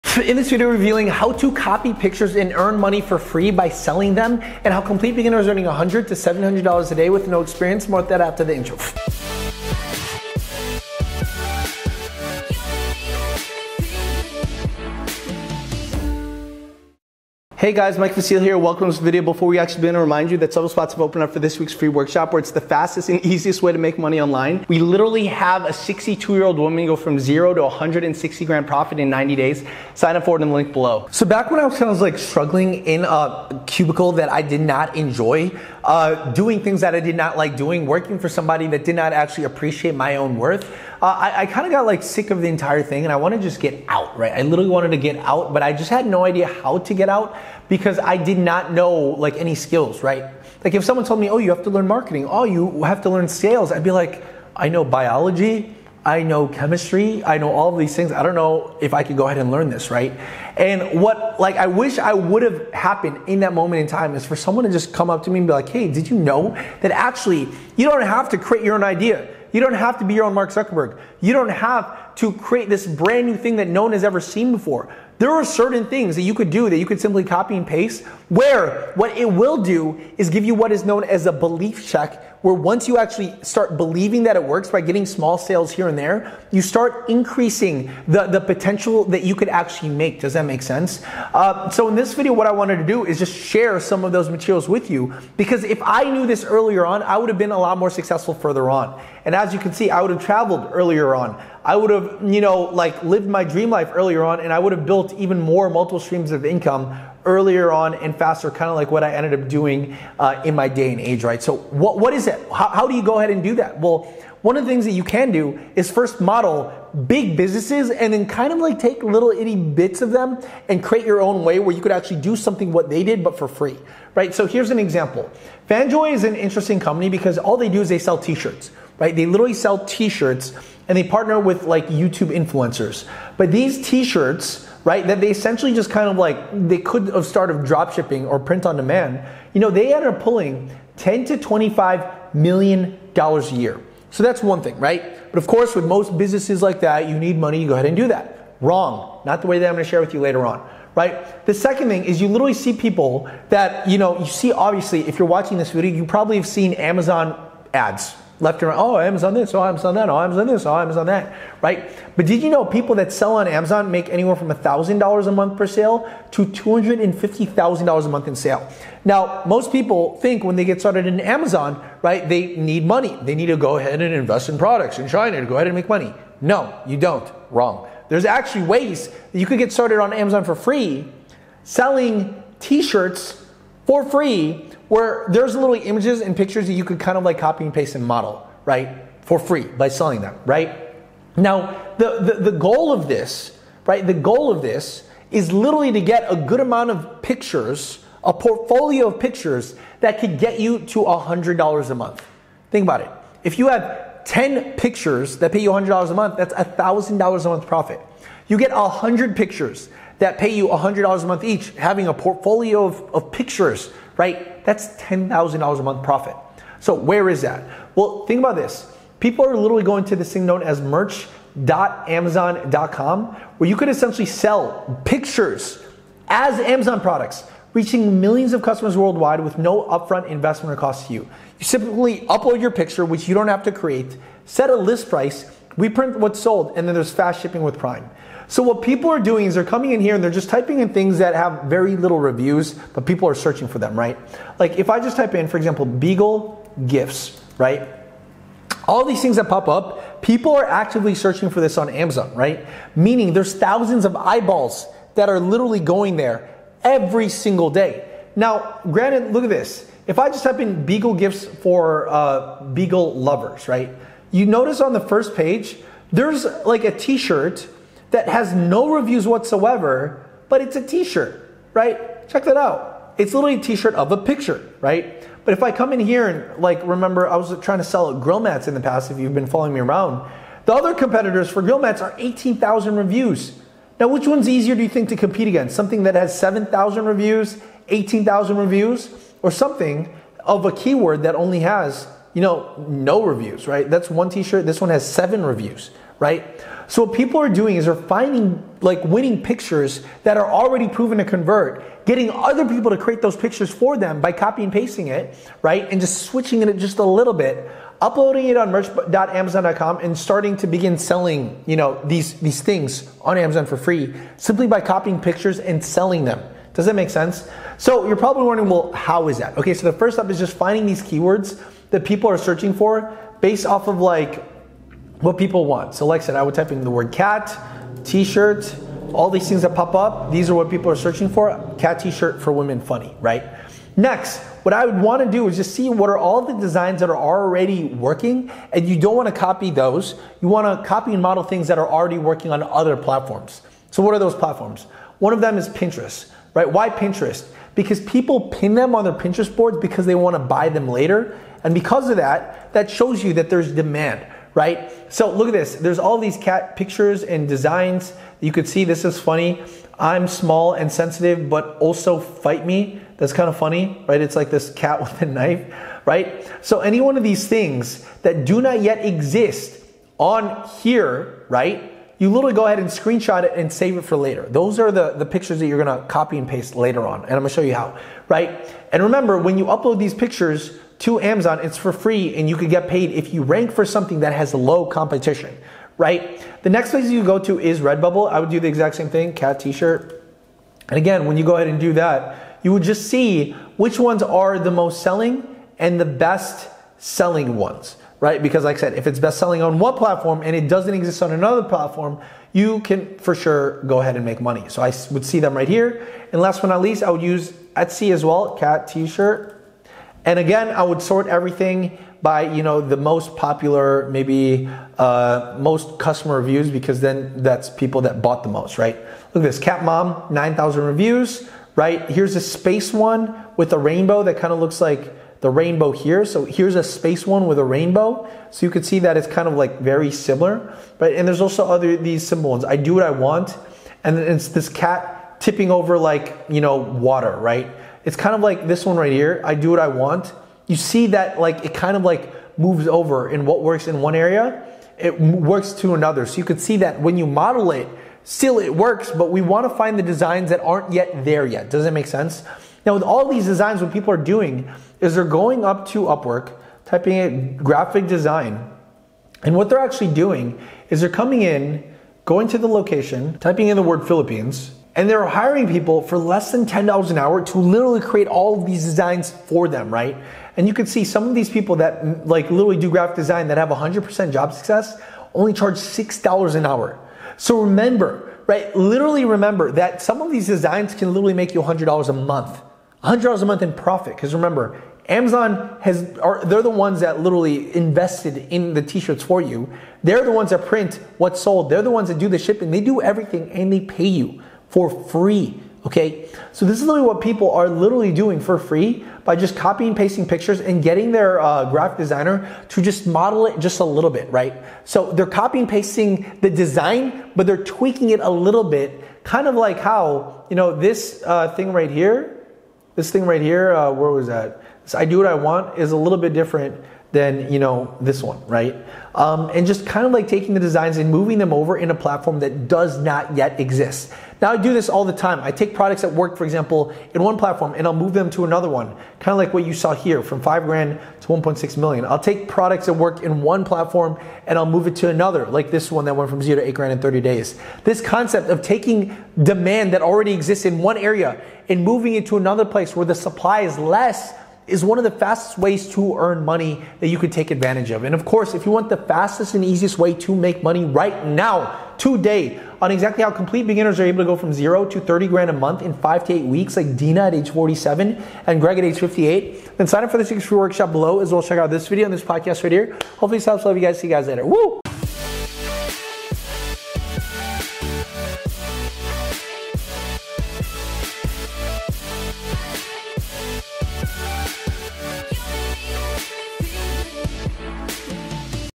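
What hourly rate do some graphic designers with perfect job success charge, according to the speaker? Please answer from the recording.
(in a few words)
$6.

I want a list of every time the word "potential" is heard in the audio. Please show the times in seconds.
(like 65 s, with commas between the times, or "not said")
88 s.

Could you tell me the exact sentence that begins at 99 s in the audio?
And as you can see, I would have traveled earlier earlier on.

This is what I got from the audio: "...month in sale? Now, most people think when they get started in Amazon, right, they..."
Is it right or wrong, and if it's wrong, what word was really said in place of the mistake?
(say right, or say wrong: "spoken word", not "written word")
right.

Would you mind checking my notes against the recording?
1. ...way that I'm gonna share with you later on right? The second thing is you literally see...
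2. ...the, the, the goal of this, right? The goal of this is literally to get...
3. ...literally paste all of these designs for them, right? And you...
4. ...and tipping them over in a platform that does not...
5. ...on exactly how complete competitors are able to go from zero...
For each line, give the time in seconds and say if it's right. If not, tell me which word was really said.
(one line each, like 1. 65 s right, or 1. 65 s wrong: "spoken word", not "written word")
1. 149 s right
2. 191 s right
3. 467 s wrong: "create", not "paste"
4. 520 s wrong: "moving", not "tipping"
5. 552 s wrong: "beginners", not "competitors".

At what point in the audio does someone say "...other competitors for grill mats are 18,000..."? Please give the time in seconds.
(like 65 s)
280 s.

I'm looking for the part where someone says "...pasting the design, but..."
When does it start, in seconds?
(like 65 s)
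505 s.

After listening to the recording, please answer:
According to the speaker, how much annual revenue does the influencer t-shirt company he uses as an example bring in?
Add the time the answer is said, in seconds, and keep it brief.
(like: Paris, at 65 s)
10 to 25 million dollars, at 140 s.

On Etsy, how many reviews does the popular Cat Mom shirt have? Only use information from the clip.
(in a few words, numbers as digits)
9,000.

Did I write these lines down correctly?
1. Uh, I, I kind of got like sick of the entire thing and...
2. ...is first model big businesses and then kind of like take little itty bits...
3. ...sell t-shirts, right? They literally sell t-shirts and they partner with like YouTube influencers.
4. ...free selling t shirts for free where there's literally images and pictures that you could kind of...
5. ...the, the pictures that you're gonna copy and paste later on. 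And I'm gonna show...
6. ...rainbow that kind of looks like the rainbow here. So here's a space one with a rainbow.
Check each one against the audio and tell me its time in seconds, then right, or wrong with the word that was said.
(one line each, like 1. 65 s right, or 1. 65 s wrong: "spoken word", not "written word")
1. 41 s right
2. 115 s right
3. 127 s right
4. 180 s right
5. 374 s right
6. 423 s right.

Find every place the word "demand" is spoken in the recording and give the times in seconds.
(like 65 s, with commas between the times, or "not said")
138 s, 353 s, 539 s.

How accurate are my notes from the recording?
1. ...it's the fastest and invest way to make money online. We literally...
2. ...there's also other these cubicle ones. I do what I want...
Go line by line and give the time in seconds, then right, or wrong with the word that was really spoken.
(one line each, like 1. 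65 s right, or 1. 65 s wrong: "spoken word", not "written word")
1. 22 s wrong: "easiest", not "invest"
2. 431 s wrong: "simple", not "cubicle".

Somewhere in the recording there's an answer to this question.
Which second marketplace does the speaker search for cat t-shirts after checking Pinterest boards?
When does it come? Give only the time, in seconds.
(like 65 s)
387 s.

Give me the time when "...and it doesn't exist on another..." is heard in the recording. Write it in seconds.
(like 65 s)
400 s.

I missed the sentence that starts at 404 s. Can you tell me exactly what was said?
So I would see them right here.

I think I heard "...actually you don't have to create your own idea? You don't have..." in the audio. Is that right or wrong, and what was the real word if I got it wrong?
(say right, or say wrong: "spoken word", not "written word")
right.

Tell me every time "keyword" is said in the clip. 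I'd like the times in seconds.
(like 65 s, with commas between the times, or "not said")
290 s, 321 s.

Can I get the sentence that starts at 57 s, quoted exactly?
I know all of these things.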